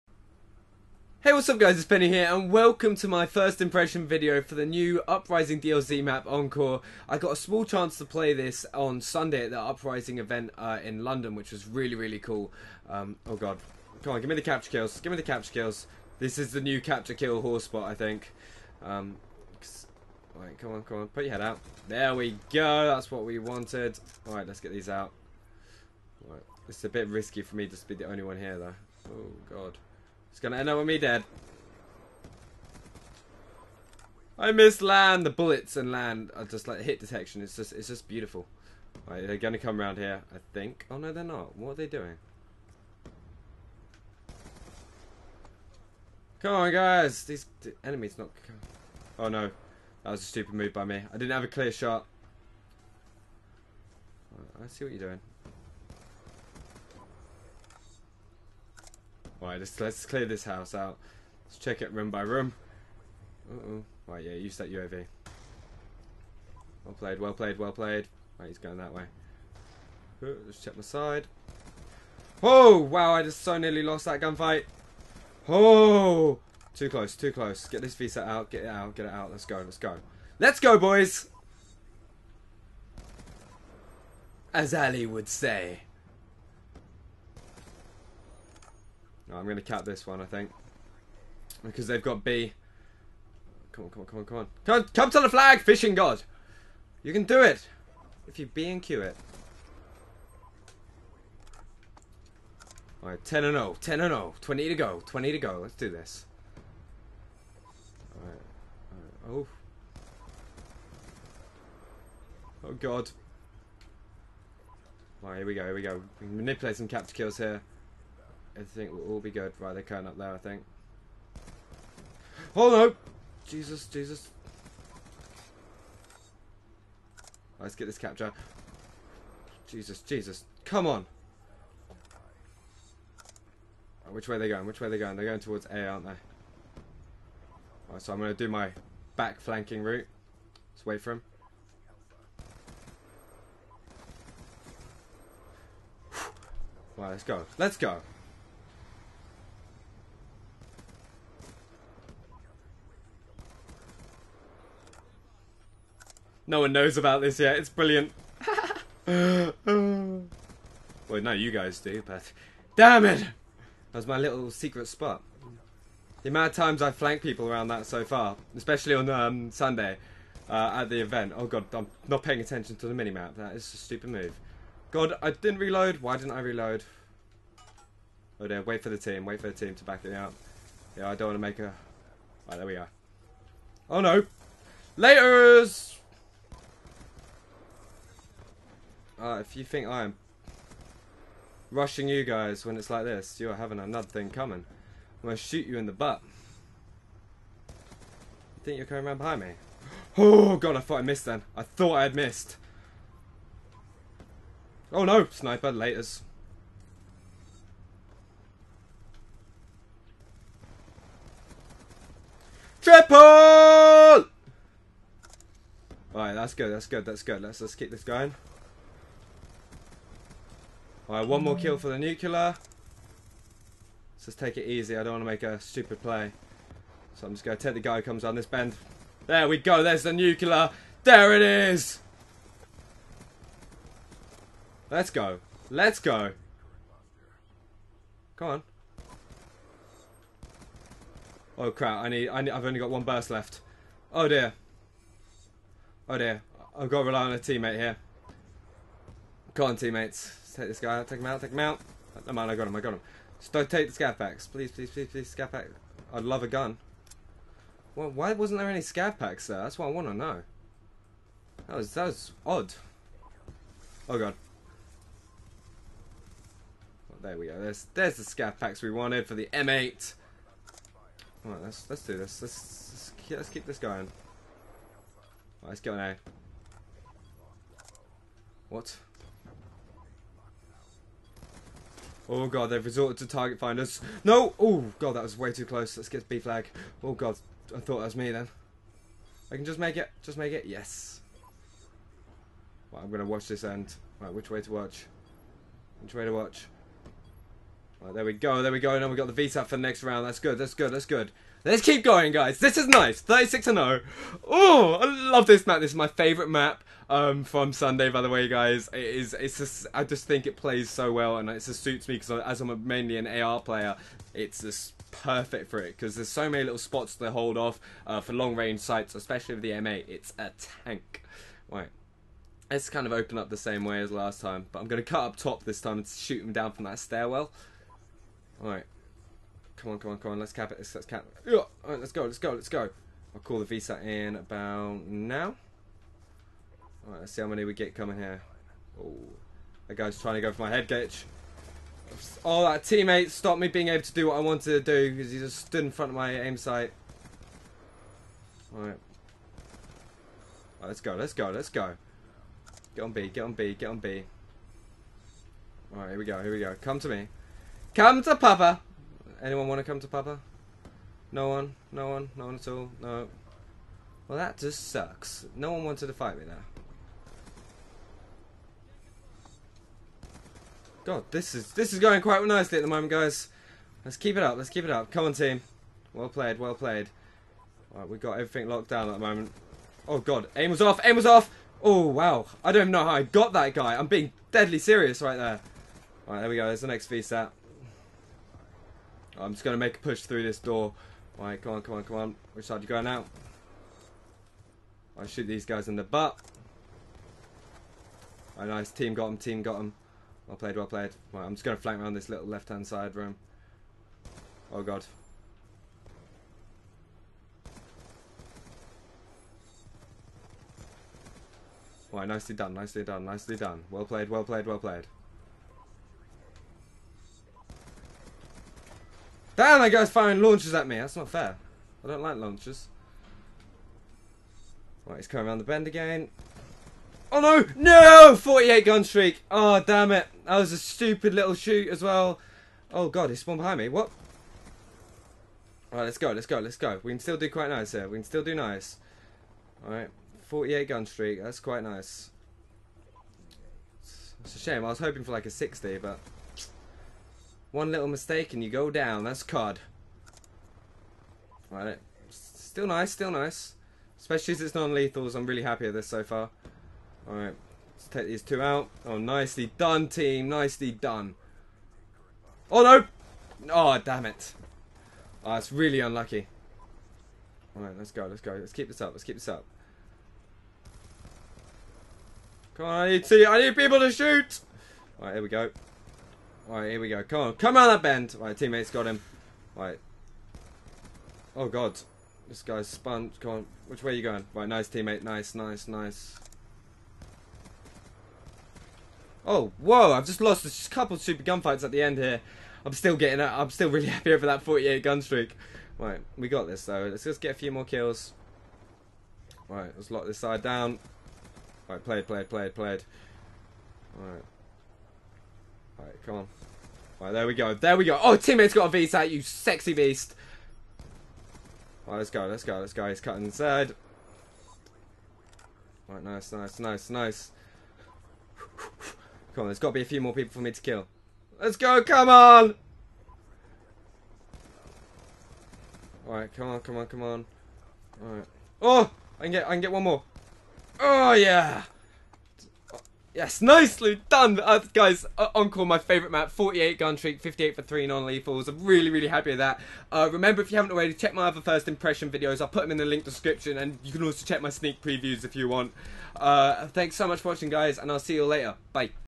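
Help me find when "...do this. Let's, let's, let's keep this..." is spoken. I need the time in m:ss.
4:32.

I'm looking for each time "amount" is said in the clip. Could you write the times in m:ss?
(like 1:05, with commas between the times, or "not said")
2:46.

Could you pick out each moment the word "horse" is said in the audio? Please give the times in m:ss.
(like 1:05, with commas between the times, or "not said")
0:17.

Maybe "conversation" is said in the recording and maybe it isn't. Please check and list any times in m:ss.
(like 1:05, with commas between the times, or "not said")
not said.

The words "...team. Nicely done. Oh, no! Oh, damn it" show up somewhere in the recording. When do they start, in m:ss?
7:40.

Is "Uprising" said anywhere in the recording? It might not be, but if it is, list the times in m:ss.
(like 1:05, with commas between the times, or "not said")
0:05, 0:09.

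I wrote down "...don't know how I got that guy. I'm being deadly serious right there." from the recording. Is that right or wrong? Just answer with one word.
right.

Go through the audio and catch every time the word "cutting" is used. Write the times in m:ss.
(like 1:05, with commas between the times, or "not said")
8:33.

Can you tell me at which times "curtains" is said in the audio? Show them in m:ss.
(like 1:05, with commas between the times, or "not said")
not said.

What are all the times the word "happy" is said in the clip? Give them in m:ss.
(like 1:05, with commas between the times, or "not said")
7:35, 8:14, 8:59.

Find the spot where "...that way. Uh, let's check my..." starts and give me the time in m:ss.
1:08.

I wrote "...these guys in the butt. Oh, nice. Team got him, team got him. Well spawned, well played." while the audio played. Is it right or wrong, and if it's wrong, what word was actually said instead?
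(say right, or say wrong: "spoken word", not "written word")
wrong: "played", not "spawned".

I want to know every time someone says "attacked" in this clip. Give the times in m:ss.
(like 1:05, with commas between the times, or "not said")
not said.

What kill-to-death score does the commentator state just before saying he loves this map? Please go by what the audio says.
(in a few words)
36 and 0.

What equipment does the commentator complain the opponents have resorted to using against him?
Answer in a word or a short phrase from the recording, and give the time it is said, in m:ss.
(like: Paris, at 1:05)
target finders, at 4:43.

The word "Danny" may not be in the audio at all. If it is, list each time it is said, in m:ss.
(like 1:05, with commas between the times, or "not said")
not said.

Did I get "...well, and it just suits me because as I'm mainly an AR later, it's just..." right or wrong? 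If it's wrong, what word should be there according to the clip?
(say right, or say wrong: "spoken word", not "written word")
wrong: "player", not "later".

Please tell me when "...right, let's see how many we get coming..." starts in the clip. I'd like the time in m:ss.
5:37.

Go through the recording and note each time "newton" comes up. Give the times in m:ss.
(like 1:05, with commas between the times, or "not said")
not said.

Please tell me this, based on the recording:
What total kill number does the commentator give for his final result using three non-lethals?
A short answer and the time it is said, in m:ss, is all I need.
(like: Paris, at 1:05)
58, at 8:57.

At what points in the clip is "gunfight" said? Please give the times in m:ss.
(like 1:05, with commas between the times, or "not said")
1:14, 8:11.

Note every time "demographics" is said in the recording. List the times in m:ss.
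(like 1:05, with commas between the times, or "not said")
not said.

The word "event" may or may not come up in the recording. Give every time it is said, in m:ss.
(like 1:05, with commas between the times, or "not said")
0:10, 2:51.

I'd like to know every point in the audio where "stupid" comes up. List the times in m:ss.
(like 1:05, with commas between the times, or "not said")
0:50, 2:53, 3:45, 7:10.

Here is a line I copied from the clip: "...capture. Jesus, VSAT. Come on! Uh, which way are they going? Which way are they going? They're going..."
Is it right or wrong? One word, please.
wrong.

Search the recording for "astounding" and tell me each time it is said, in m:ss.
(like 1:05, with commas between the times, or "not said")
not said.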